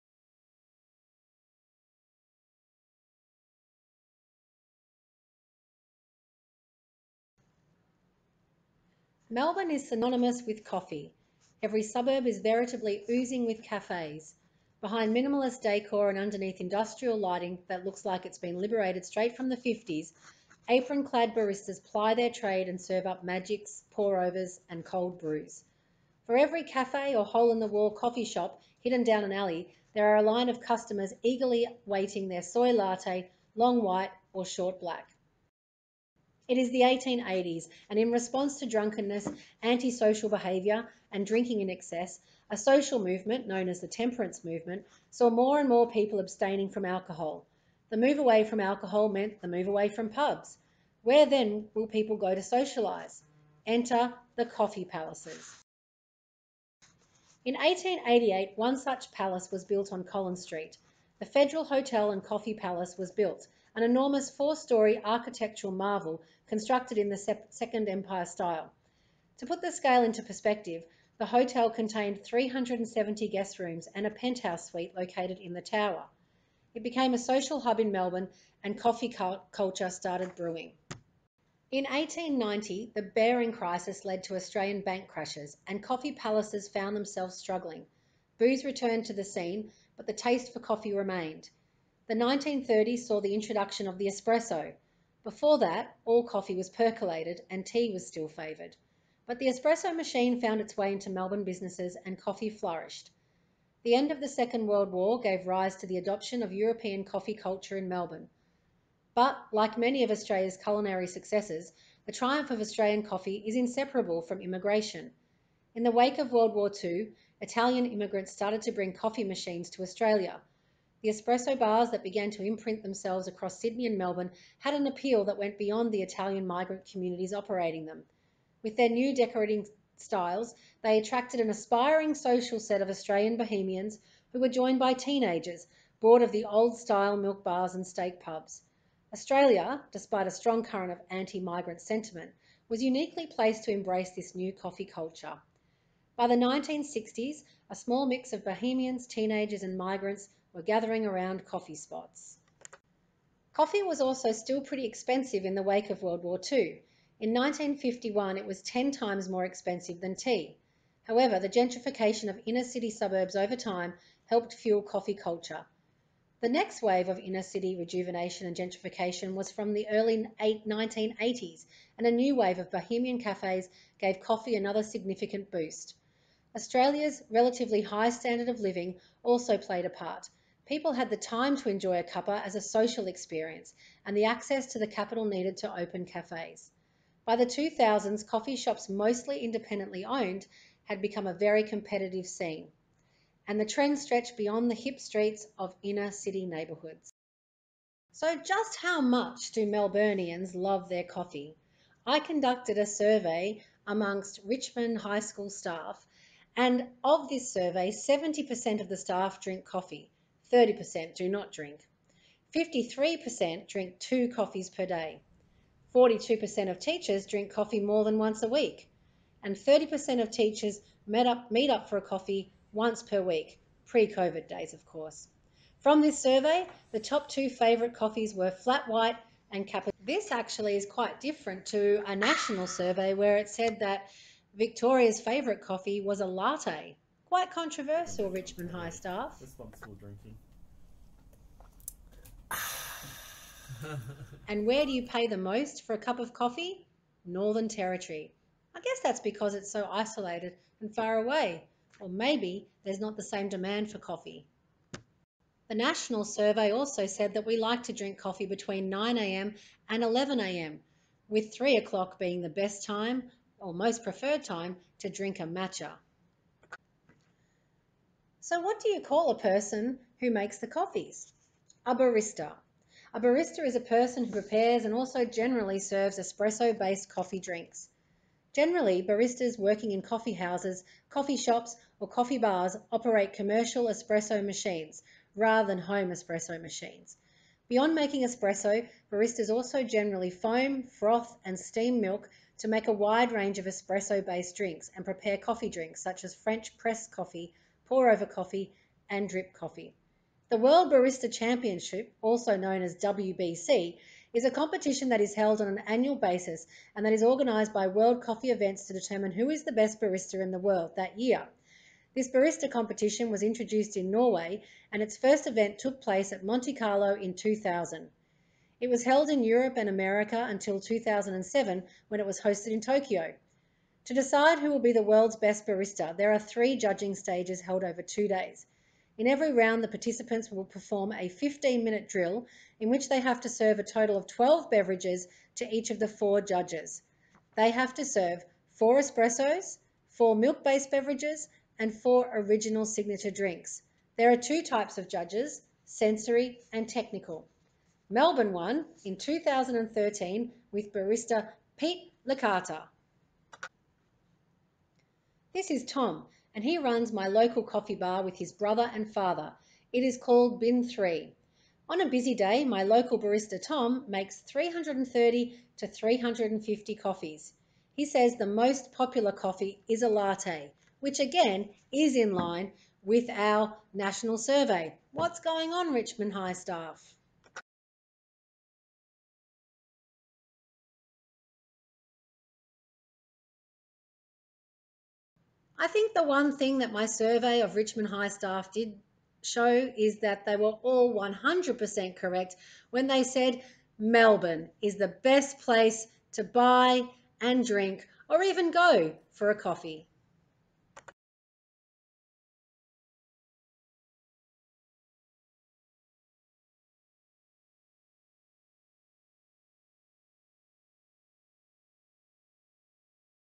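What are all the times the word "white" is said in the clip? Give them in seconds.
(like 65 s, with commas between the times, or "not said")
33 s, 228 s.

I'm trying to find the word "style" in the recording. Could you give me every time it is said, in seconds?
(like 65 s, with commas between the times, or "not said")
68 s, 129 s, 136 s.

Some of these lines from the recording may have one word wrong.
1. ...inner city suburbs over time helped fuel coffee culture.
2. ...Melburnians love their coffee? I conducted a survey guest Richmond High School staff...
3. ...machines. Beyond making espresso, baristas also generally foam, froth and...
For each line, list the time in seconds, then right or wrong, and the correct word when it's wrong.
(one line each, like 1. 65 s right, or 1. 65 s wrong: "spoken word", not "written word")
1. 162 s right
2. 199 s wrong: "amongst", not "guest"
3. 286 s right.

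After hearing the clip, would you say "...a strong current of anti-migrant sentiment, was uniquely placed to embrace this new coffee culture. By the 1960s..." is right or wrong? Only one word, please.
right.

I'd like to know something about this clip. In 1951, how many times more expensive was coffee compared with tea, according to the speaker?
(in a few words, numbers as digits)
10 times.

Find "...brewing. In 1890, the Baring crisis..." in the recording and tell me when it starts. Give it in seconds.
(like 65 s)
80 s.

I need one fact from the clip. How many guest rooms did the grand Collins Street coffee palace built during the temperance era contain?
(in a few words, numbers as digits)
370.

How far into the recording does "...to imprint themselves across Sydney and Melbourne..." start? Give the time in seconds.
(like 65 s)
122 s.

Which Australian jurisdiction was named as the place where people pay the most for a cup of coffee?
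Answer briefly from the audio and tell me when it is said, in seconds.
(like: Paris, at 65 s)
Northern Territory, at 247 s.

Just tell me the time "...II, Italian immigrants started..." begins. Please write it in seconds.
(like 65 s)
116 s.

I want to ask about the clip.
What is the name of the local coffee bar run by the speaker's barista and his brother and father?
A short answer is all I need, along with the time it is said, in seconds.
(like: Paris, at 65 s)
Bin 3, at 360 s.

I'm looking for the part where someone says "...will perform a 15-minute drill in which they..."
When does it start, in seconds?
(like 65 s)
330 s.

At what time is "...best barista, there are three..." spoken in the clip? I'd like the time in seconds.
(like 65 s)
325 s.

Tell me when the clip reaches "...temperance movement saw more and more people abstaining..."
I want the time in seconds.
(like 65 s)
43 s.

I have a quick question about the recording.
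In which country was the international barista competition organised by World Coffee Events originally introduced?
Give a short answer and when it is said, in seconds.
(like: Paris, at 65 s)
Norway, at 314 s.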